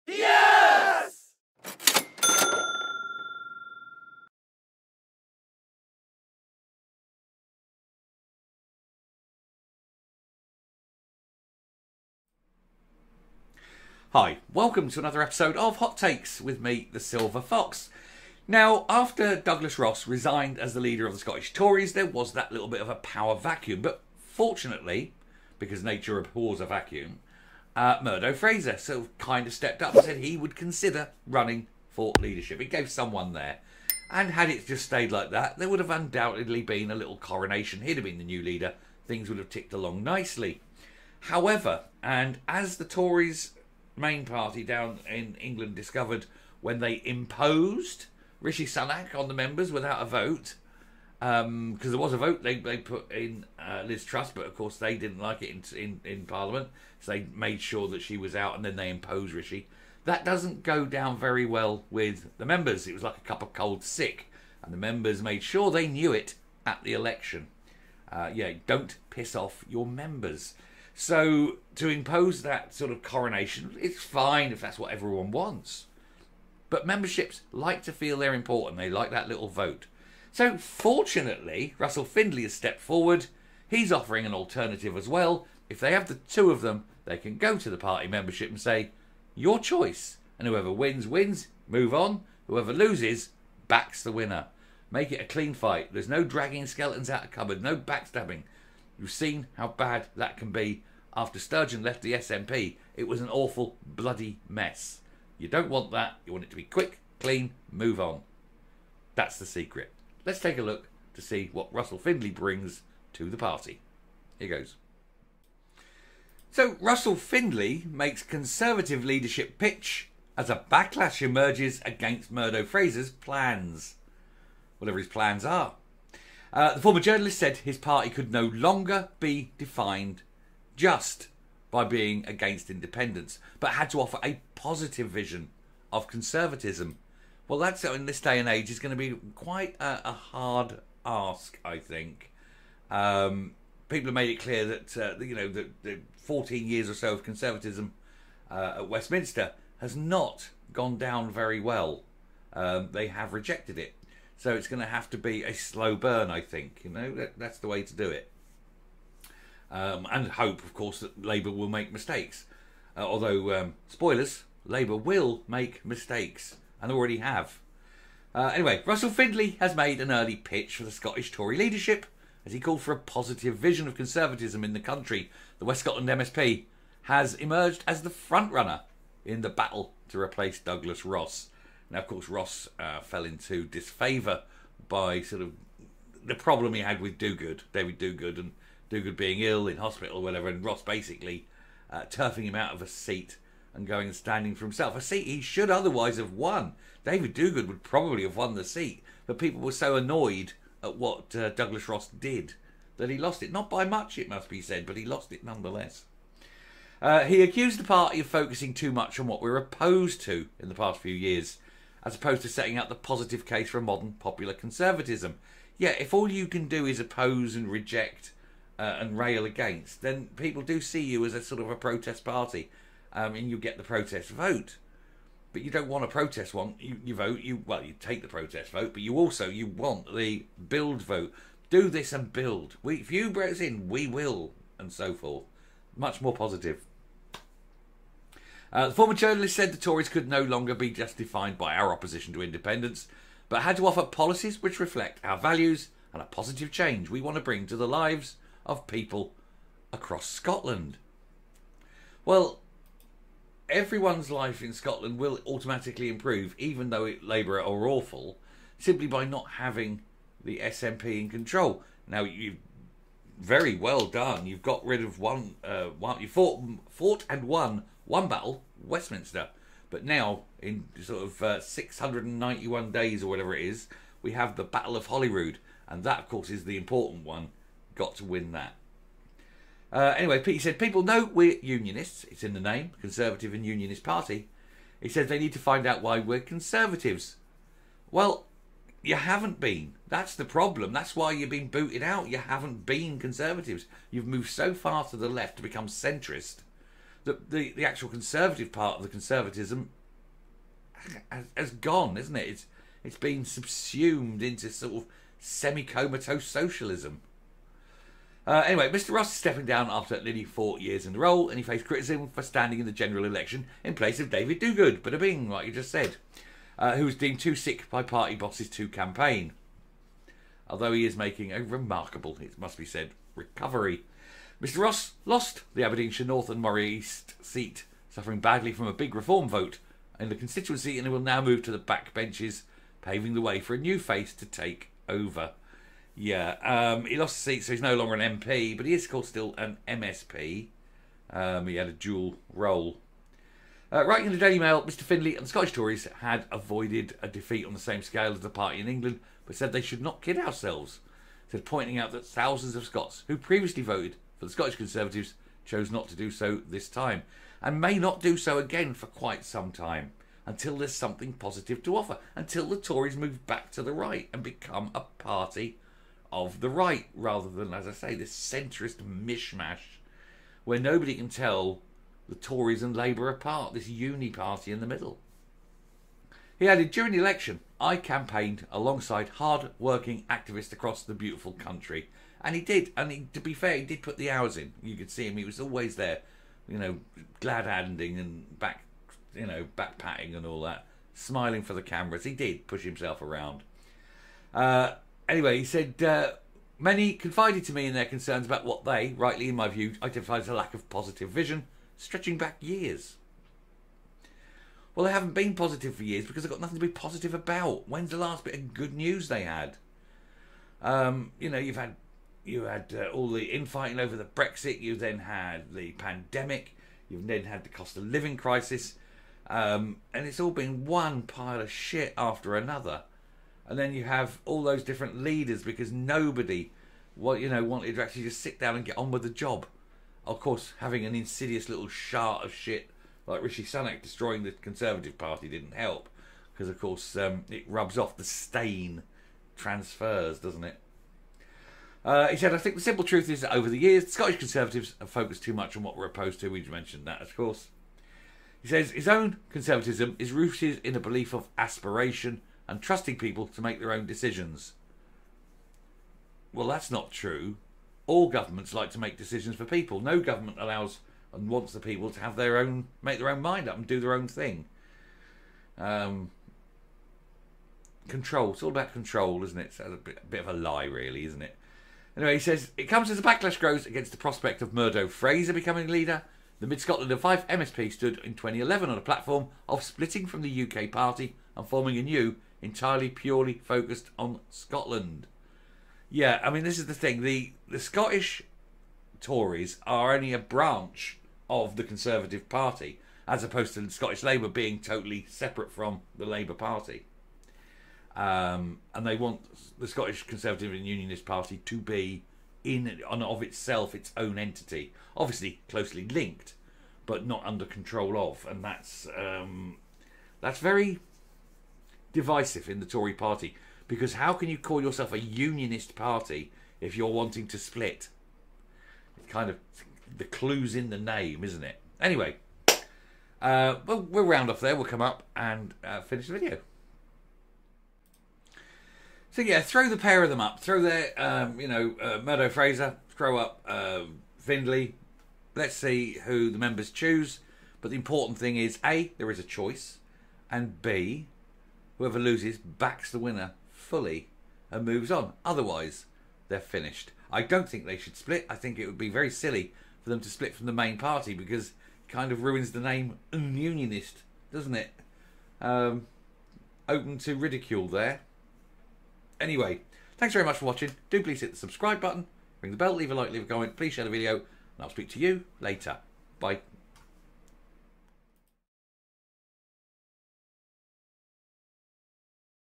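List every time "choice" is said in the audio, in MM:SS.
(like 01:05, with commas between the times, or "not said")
01:29, 08:59.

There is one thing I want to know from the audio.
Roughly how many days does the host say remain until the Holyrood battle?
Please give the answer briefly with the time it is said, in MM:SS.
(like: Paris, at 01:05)
691, at 04:31.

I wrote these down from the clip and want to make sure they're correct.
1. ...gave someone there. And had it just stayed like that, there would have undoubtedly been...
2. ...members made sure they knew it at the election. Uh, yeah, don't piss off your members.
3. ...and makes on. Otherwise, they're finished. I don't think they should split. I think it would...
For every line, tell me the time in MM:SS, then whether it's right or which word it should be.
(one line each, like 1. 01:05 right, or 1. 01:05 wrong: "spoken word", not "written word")
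1. 00:32 right
2. 01:04 right
3. 09:04 wrong: "moves", not "makes".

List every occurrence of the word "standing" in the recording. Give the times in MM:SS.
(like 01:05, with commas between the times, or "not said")
03:14, 05:12.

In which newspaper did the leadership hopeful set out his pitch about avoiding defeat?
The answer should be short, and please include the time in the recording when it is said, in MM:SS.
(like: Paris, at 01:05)
Daily Mail, at 05:44.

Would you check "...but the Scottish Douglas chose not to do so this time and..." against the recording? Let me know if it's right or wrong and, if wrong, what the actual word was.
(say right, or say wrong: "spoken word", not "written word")
wrong: "Conservatives", not "Douglas".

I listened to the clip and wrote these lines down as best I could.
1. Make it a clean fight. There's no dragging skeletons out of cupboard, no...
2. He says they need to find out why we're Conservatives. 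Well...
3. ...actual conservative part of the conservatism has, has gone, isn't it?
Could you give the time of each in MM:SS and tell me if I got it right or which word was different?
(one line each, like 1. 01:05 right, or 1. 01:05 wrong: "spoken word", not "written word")
1. 01:34 right
2. 04:44 right
3. 04:57 right.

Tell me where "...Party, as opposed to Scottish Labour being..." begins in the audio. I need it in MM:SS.
08:12.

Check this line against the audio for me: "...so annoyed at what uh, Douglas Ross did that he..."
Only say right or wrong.
right.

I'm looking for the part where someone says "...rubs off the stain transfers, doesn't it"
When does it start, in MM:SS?
07:17.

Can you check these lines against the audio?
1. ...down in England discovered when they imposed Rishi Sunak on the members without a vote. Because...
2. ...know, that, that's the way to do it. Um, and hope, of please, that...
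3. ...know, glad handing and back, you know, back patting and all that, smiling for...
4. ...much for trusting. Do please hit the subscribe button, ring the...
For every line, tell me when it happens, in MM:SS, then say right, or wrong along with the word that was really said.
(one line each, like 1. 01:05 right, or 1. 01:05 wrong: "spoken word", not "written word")
1. 00:44 right
2. 02:36 wrong: "course", not "please"
3. 06:26 right
4. 09:20 wrong: "watching", not "trusting".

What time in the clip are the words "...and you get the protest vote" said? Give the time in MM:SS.
03:43.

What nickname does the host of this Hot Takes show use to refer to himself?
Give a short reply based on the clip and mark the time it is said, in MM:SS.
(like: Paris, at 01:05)
The Silver Fox, at 00:16.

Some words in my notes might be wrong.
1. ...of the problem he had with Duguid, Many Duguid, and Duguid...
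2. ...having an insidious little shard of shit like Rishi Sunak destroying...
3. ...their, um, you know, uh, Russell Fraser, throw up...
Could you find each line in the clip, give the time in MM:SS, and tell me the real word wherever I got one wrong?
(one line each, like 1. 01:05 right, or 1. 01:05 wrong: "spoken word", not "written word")
1. 03:05 wrong: "David", not "Many"
2. 07:10 right
3. 08:50 wrong: "Murdo", not "Russell".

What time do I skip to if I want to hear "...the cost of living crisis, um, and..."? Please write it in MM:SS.
06:57.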